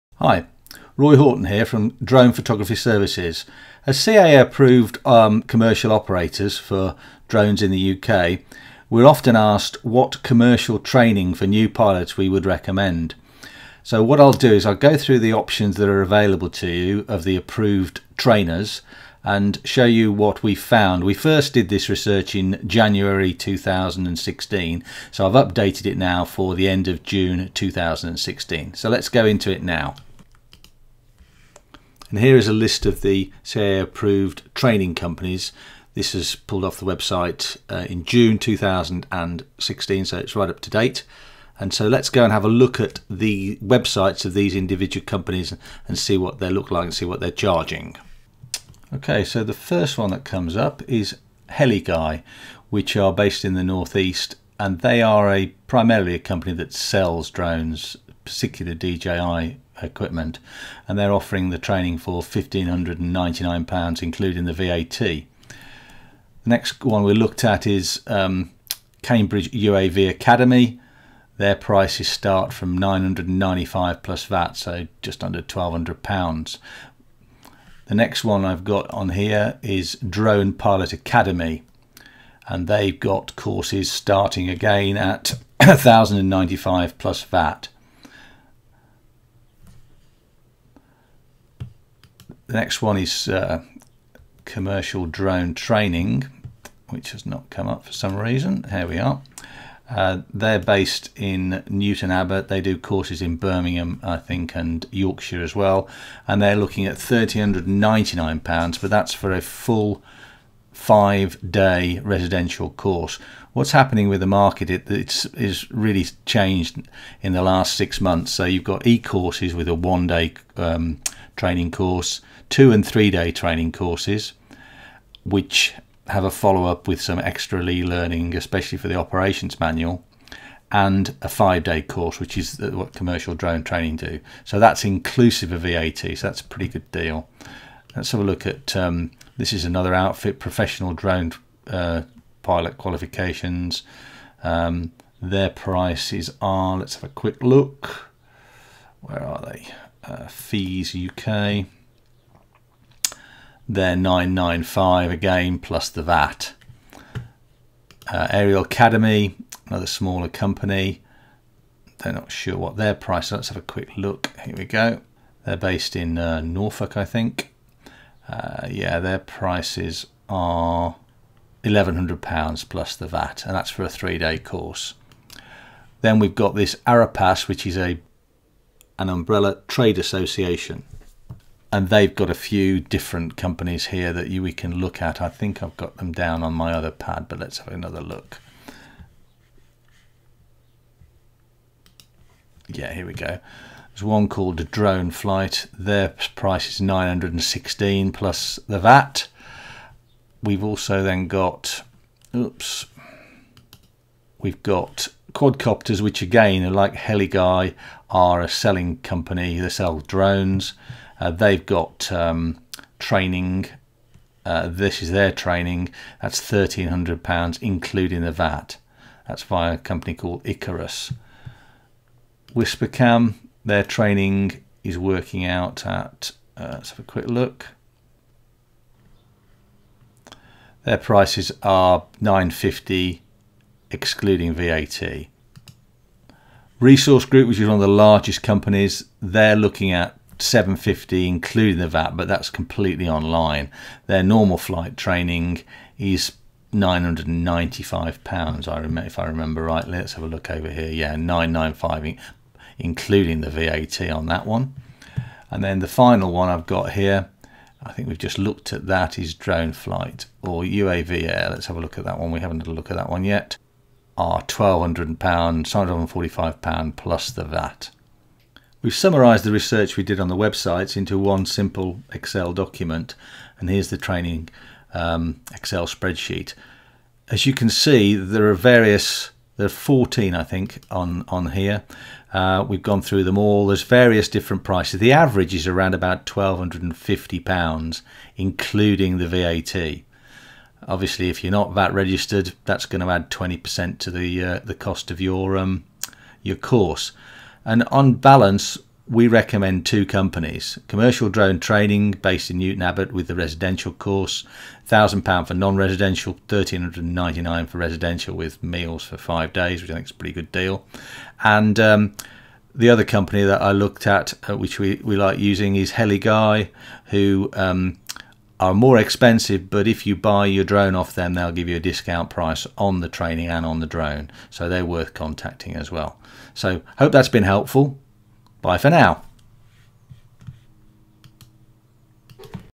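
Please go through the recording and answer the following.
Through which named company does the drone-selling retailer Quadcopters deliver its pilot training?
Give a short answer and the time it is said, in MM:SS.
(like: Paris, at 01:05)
Icarus, at 03:40.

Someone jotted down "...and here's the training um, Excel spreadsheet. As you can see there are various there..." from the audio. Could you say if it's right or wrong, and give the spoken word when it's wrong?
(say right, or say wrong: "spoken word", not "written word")
right.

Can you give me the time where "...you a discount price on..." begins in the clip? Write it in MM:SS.
05:21.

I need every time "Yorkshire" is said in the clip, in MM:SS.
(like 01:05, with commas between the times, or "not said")
01:44.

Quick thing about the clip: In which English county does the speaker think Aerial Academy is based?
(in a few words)
Norfolk.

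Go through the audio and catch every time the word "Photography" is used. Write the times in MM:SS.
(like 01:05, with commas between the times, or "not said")
00:02.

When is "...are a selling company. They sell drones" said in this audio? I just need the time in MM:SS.
03:28.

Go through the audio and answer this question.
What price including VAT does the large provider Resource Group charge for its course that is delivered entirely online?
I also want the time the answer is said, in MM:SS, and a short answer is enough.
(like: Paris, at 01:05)
£750, at 04:00.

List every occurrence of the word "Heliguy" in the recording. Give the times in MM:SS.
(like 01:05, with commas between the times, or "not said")
00:51, 03:26, 05:15.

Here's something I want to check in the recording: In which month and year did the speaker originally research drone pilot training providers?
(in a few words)
January 2016.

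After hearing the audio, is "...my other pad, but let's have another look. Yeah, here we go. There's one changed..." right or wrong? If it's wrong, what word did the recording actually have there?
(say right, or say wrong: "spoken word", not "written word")
wrong: "called", not "changed".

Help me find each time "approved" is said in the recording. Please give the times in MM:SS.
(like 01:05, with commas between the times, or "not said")
00:04, 00:17, 00:33.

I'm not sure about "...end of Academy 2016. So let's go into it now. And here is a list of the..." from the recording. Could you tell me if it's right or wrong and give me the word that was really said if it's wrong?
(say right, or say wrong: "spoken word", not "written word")
wrong: "June", not "Academy".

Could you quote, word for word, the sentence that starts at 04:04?
Their normal flight training is 995 pounds.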